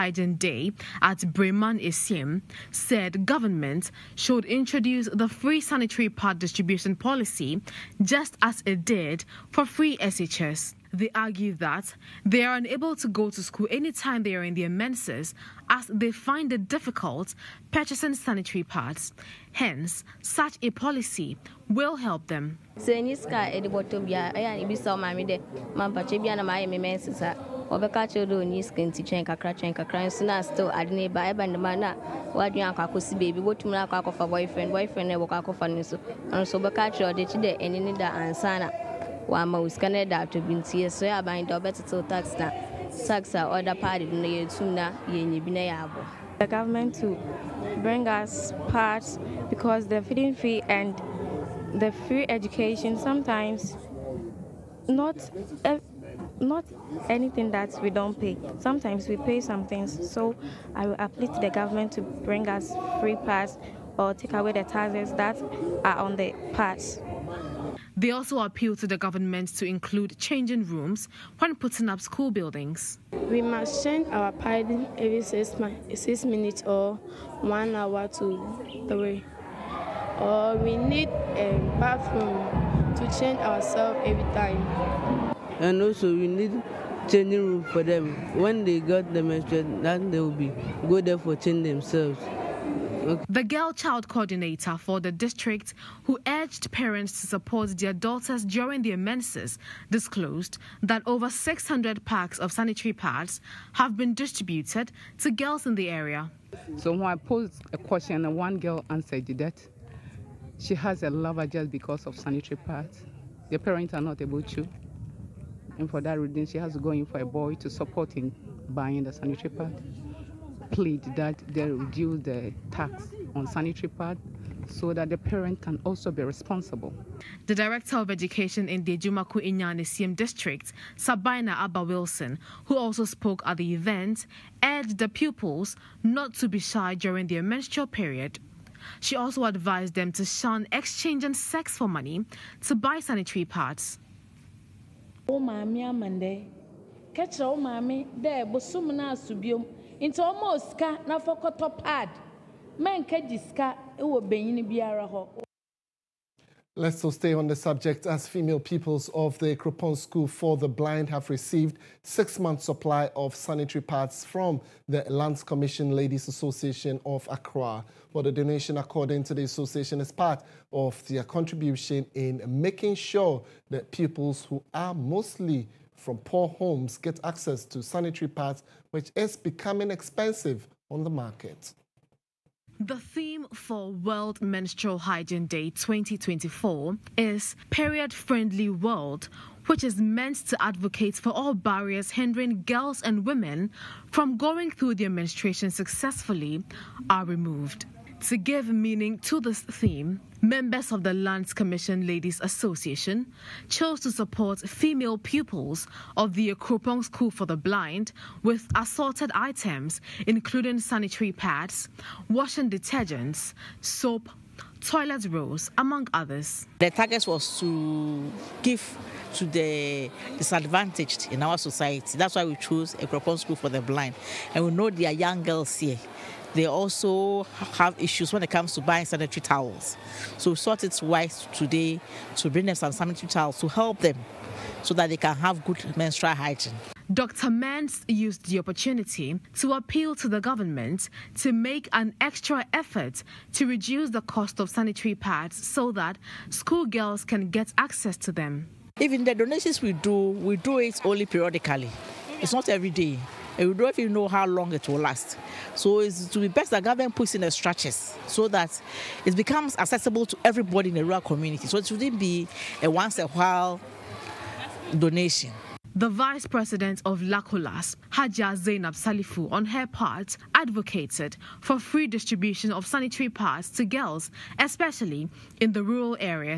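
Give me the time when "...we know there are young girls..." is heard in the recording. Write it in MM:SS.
03:44.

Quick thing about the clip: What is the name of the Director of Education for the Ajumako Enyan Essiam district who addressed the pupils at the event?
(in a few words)
Sabina Abba Wilson.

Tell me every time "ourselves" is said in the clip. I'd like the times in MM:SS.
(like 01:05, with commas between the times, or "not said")
01:23.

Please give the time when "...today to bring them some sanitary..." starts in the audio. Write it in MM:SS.
03:51.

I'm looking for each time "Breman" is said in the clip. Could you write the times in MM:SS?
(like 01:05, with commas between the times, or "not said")
00:01.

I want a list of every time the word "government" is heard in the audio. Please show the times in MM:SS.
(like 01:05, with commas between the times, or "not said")
00:03, 00:46, 01:01, 01:08, 04:00, 04:16.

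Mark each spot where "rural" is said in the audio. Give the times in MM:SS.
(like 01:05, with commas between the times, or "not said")
04:21, 04:35.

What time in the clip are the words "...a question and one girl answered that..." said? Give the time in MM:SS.
01:47.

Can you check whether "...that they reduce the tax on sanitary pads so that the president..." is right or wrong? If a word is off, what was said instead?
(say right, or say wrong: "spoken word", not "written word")
wrong: "parent", not "president".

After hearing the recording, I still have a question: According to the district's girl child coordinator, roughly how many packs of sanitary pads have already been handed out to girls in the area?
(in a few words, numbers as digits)
over 600.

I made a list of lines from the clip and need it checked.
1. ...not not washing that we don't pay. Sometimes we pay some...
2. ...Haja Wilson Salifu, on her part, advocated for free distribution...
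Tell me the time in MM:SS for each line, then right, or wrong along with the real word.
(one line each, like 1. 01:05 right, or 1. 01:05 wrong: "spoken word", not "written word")
1. 00:54 wrong: "anything", not "washing"
2. 04:28 wrong: "Zainab", not "Wilson".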